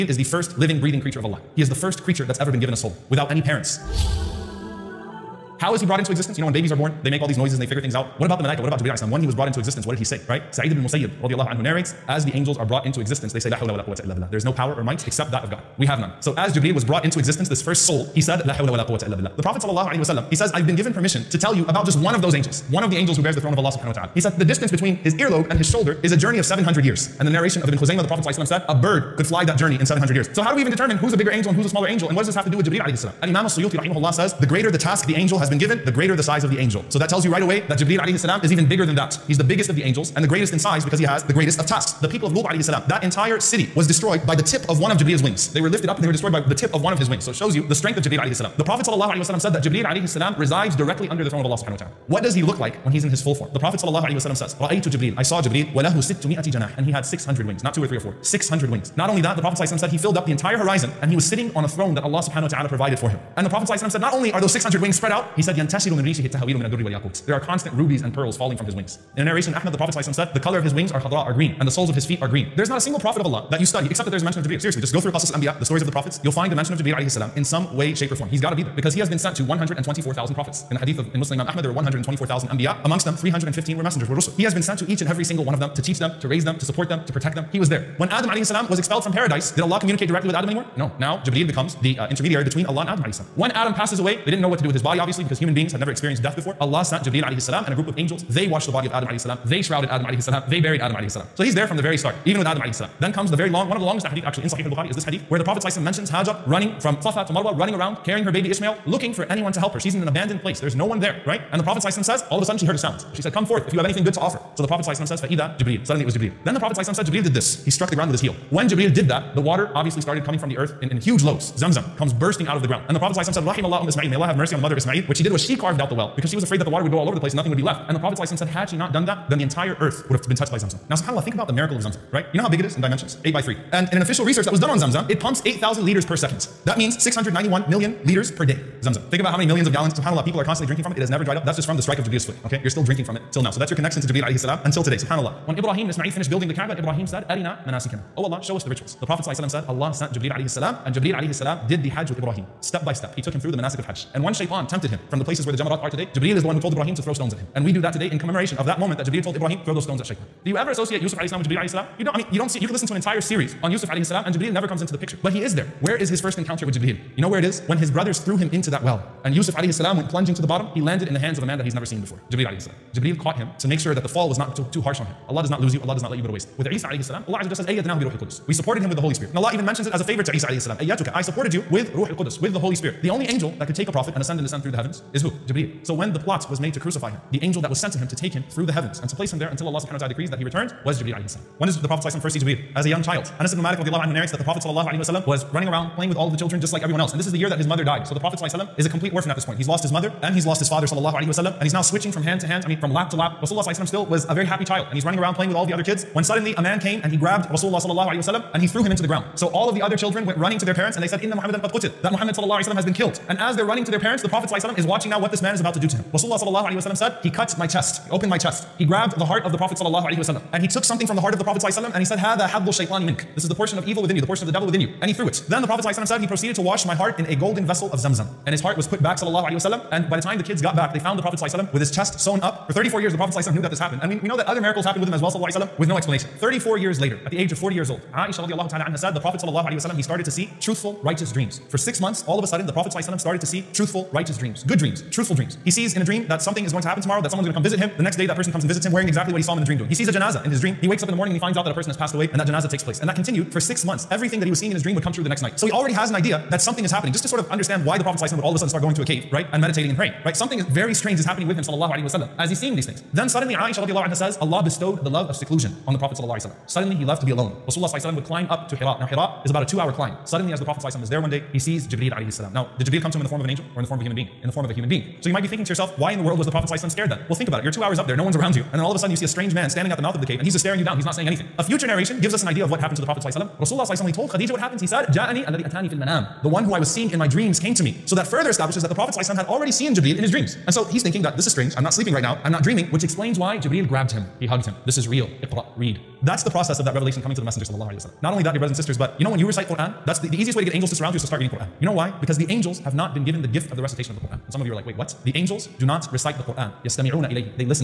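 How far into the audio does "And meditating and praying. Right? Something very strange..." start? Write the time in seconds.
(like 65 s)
259 s.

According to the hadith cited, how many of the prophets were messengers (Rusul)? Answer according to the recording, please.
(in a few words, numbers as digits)
315.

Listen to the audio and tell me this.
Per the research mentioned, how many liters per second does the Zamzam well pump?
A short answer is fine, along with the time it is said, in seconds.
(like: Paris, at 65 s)
8,000, at 135 s.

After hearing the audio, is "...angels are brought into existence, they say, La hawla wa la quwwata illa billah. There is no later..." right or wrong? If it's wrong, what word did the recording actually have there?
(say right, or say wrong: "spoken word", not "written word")
wrong: "power", not "later".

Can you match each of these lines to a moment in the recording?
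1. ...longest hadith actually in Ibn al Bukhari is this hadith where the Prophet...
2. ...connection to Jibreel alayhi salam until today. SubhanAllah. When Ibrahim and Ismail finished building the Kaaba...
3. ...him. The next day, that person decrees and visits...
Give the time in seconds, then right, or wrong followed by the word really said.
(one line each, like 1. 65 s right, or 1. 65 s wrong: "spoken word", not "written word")
1. 103 s wrong: "Sahih", not "Ibn"
2. 143 s right
3. 247 s wrong: "comes", not "decrees".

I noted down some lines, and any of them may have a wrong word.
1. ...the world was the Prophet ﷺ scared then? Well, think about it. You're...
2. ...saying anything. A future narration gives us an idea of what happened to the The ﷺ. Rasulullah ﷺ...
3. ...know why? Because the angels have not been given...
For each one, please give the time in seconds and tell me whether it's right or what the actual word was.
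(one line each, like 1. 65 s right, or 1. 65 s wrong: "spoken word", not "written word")
1. 276 s right
2. 281 s wrong: "Prophet", not "The"
3. 301 s right.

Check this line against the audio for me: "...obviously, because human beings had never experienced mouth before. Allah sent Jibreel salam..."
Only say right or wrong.
wrong.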